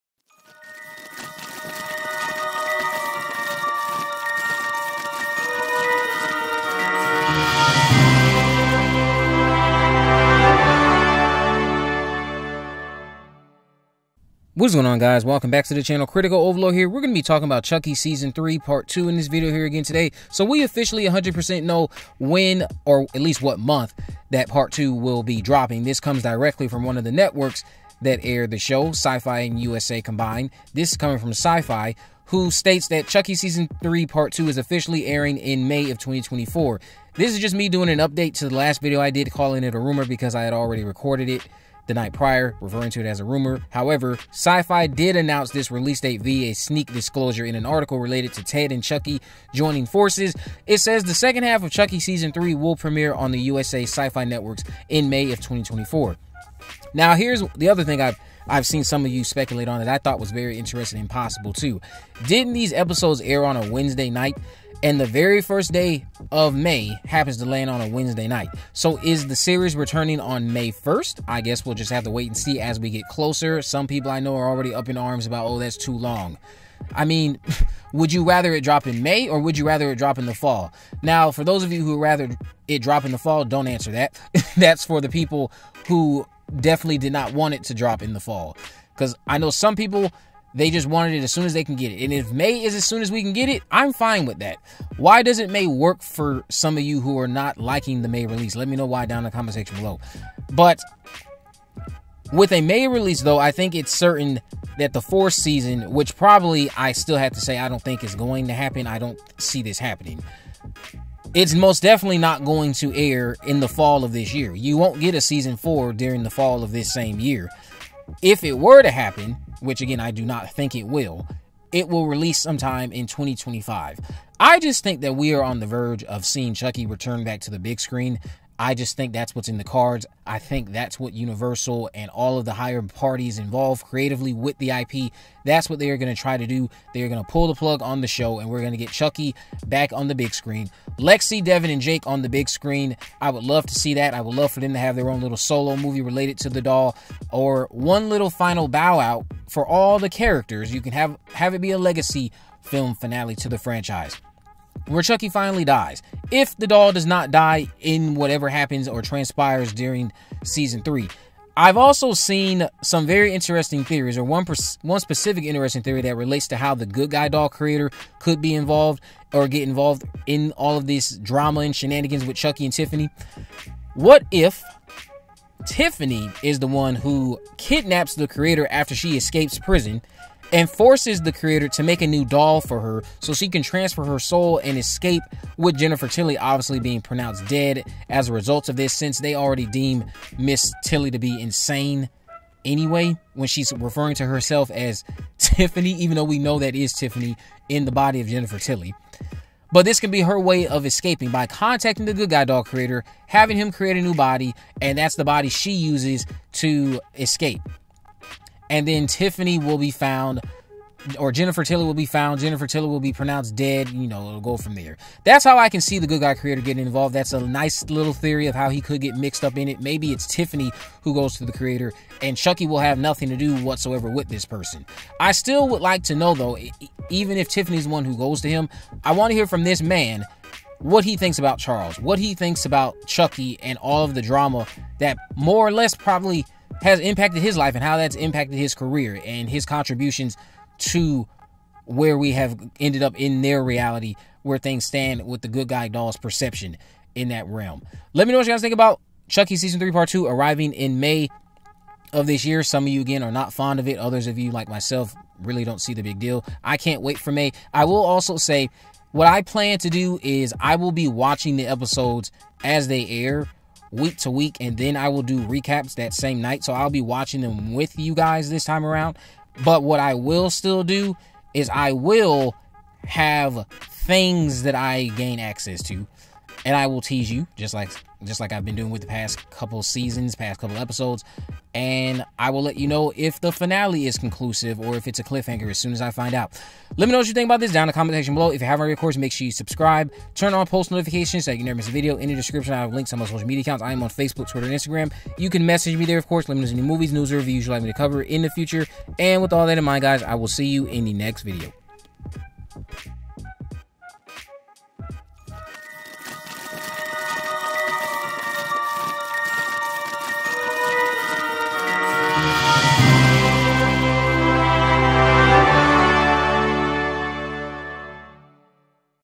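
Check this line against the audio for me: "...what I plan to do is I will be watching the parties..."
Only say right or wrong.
wrong.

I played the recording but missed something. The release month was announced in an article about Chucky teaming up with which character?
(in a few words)
Ted.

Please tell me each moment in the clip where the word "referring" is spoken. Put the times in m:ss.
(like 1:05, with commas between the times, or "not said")
0:42, 3:13.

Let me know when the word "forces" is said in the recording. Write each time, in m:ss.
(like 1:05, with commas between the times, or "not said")
0:49, 3:00.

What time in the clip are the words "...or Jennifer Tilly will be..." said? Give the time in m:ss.
3:31.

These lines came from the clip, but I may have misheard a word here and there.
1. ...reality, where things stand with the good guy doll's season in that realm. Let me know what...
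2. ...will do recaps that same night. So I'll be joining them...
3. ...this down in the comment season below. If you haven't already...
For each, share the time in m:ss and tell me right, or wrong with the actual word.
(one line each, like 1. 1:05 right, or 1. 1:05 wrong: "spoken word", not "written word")
1. 4:03 wrong: "perception", not "season"
2. 4:25 wrong: "watching", not "joining"
3. 4:47 wrong: "section", not "season".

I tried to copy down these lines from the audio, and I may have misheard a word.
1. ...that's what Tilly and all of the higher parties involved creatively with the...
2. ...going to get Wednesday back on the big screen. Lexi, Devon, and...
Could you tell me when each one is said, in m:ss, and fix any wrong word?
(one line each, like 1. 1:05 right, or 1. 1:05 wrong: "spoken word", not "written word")
1. 2:10 wrong: "Universal", not "Tilly"
2. 2:18 wrong: "Chucky", not "Wednesday".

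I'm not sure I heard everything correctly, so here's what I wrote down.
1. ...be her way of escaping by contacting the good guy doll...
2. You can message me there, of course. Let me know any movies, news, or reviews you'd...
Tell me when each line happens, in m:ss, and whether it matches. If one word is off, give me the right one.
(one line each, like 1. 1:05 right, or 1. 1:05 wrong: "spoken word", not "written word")
1. 3:20 right
2. 4:55 right.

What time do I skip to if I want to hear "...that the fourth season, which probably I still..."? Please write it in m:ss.
1:44.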